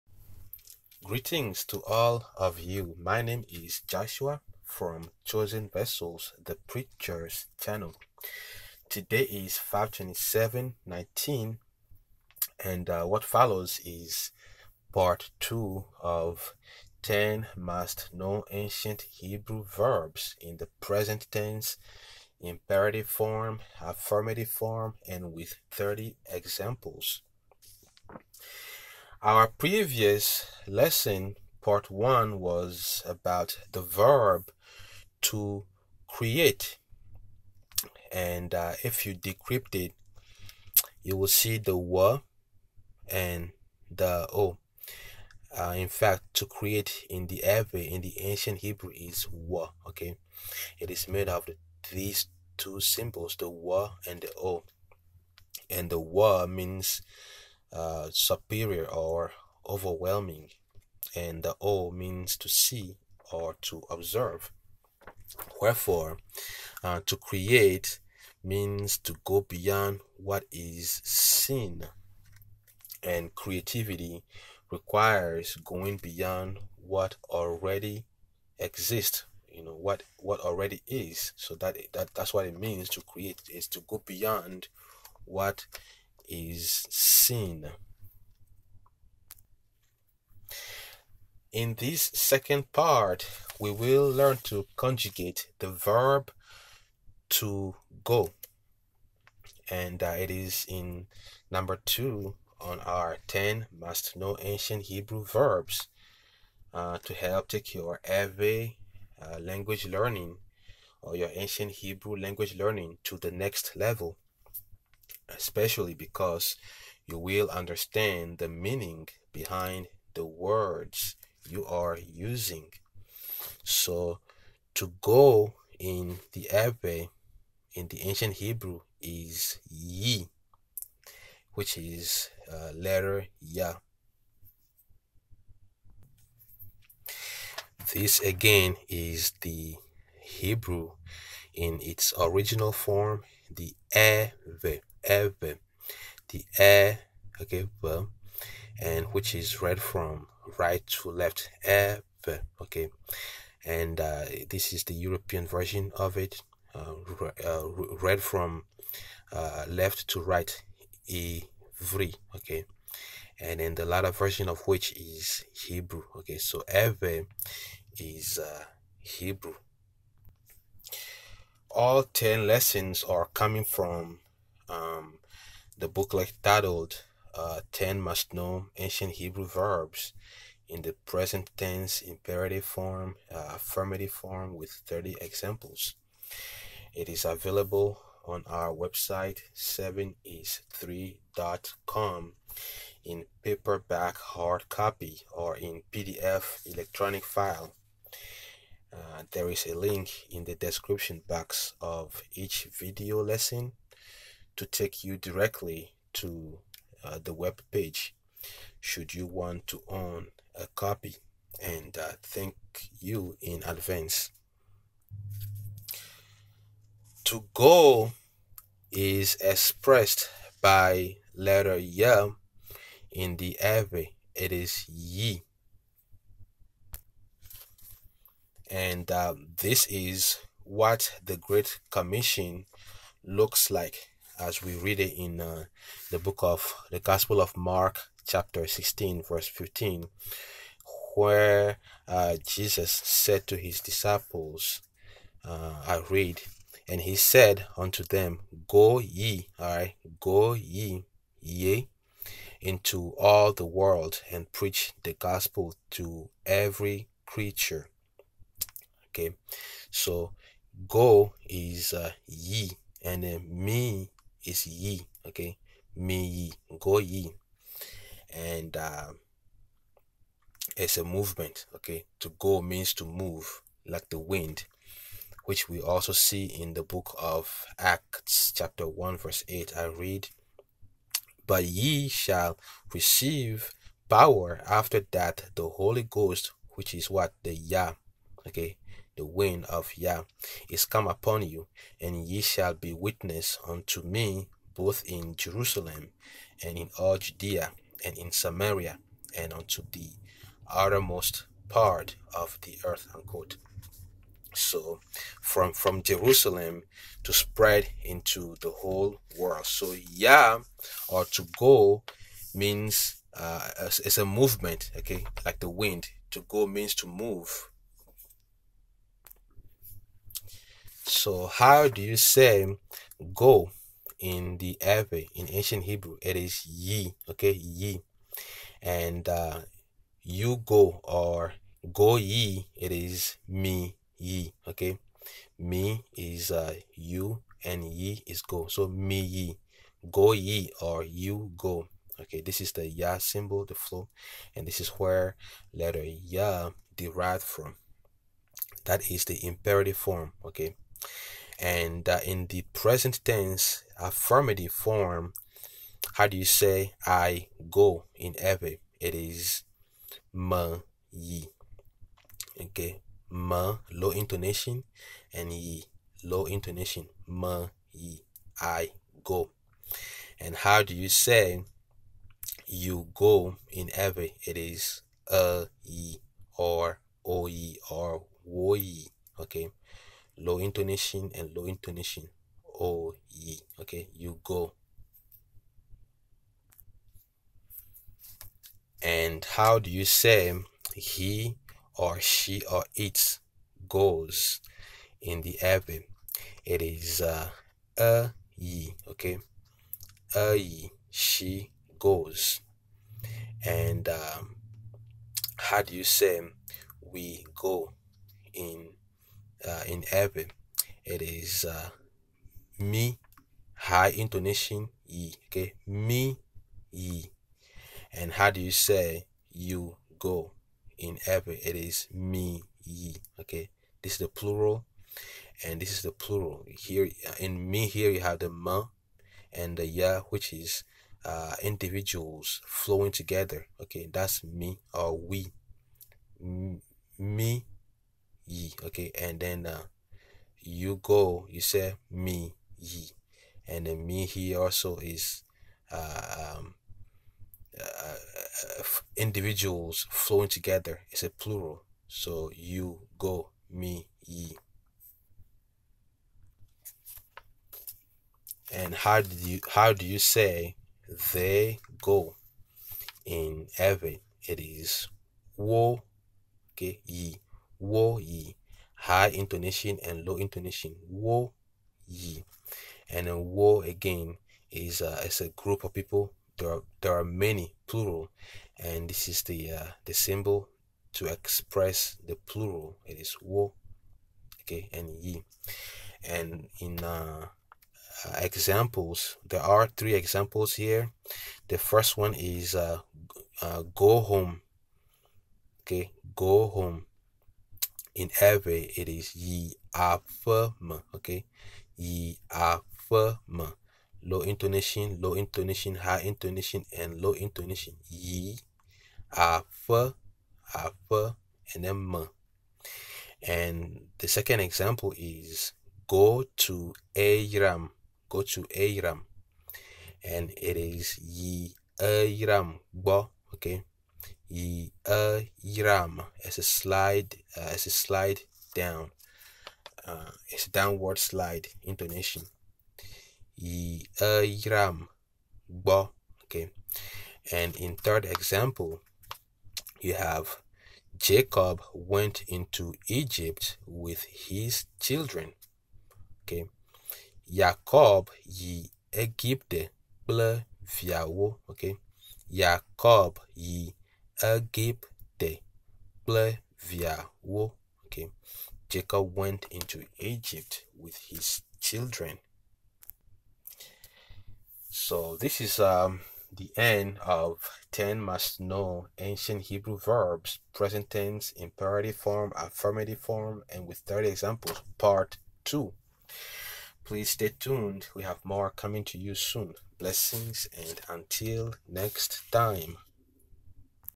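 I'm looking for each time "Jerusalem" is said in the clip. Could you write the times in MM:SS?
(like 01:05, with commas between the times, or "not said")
04:55, 05:06.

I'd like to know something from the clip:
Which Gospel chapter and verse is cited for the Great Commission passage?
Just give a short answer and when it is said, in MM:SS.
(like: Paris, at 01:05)
Mark 16:15, at 03:57.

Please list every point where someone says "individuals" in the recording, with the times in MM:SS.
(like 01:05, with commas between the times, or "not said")
07:11, 07:29.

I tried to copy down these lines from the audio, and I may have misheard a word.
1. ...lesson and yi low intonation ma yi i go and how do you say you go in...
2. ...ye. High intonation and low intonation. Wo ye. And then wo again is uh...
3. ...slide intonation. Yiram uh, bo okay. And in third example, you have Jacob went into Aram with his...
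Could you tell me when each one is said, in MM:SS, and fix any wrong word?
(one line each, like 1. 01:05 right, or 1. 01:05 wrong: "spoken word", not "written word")
1. 06:04 wrong: "intonation", not "lesson"
2. 07:48 right
3. 08:51 wrong: "Egypt", not "Aram".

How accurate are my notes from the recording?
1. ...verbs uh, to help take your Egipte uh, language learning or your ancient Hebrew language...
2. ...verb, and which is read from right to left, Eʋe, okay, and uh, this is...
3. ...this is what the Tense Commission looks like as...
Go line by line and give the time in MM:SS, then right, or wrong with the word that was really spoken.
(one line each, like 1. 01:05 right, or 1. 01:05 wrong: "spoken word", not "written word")
1. 01:45 wrong: "Eʋe", not "Egipte"
2. 02:27 right
3. 03:49 wrong: "Great", not "Tense".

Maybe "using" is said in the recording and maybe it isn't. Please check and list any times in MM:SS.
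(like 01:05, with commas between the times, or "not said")
02:01.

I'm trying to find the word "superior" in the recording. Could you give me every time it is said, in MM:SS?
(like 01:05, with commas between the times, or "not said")
00:58.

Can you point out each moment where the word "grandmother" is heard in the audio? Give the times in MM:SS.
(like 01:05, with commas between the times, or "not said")
not said.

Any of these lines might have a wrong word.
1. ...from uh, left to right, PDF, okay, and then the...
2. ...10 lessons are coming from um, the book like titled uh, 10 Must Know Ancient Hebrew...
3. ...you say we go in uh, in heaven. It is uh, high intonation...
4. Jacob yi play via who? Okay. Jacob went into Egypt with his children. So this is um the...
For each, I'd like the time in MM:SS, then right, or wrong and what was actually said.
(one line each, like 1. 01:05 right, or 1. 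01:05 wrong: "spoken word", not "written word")
1. 02:38 wrong: "Ivri", not "PDF"
2. 02:52 right
3. 06:45 right
4. 09:12 right.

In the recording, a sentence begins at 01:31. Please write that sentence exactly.
In this second part, we will learn to conjugate the verb to go.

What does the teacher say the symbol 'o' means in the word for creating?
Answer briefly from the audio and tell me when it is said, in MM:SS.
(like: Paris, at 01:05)
To see or to observe, at 01:02.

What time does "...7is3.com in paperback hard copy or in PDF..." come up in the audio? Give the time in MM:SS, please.
03:09.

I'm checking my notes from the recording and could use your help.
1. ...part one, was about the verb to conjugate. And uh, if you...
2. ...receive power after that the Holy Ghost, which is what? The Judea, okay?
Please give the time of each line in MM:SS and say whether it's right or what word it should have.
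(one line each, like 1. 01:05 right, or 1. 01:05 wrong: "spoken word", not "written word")
1. 00:31 wrong: "create", not "conjugate"
2. 04:42 wrong: "Yah", not "Judea".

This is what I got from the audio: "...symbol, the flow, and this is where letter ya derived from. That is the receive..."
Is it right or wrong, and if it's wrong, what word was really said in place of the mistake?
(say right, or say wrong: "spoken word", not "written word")
wrong: "imperative", not "receive".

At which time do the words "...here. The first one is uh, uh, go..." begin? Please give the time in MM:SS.
08:10.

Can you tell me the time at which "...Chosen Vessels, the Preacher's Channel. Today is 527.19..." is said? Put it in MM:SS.
00:05.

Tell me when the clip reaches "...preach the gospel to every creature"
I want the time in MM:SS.
04:14.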